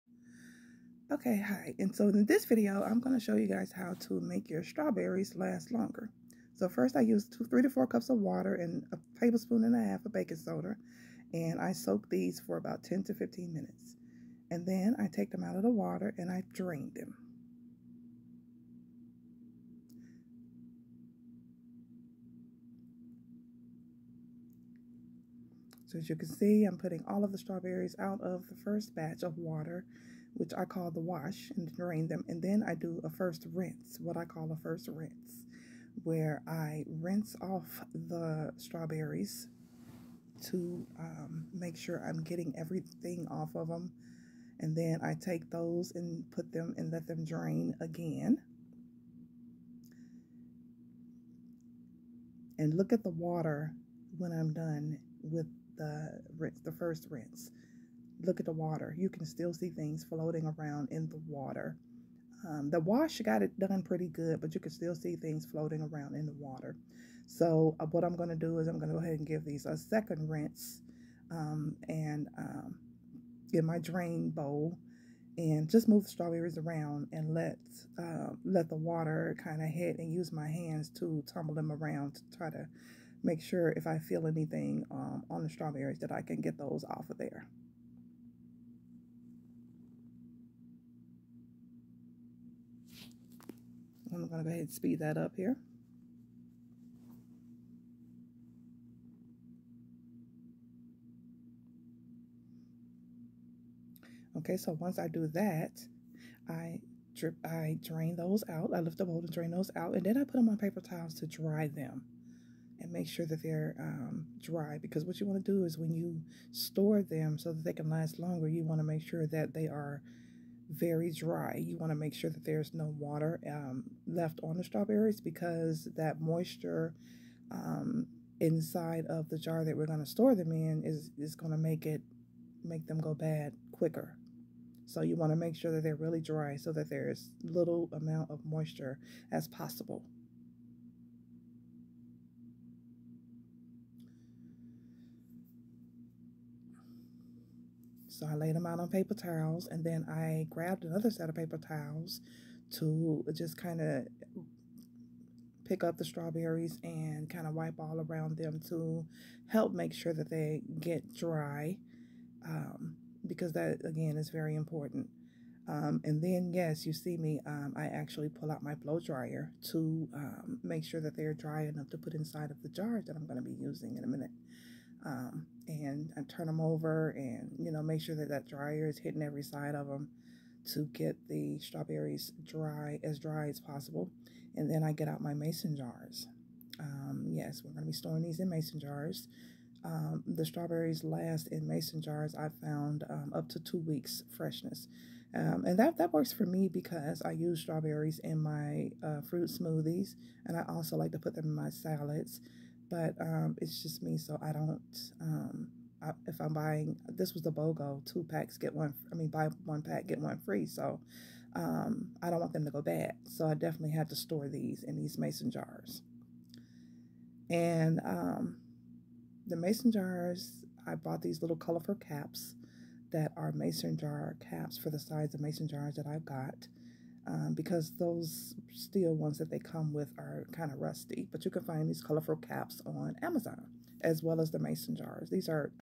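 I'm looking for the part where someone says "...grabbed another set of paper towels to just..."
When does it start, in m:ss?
2:30.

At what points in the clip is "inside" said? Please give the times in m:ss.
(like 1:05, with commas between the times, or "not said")
2:08, 2:52.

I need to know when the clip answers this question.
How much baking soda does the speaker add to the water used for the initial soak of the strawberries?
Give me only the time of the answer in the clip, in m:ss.
0:08.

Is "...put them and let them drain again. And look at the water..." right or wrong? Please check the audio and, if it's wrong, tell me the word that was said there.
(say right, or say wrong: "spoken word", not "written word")
right.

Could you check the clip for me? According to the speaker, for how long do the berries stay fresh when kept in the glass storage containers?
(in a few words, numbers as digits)
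2 weeks.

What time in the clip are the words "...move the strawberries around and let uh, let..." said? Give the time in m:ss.
1:15.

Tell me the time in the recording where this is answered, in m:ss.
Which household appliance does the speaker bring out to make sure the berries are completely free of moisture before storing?
2:48.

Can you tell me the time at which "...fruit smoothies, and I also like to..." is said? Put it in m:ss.
3:19.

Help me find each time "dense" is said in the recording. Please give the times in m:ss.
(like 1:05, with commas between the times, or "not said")
not said.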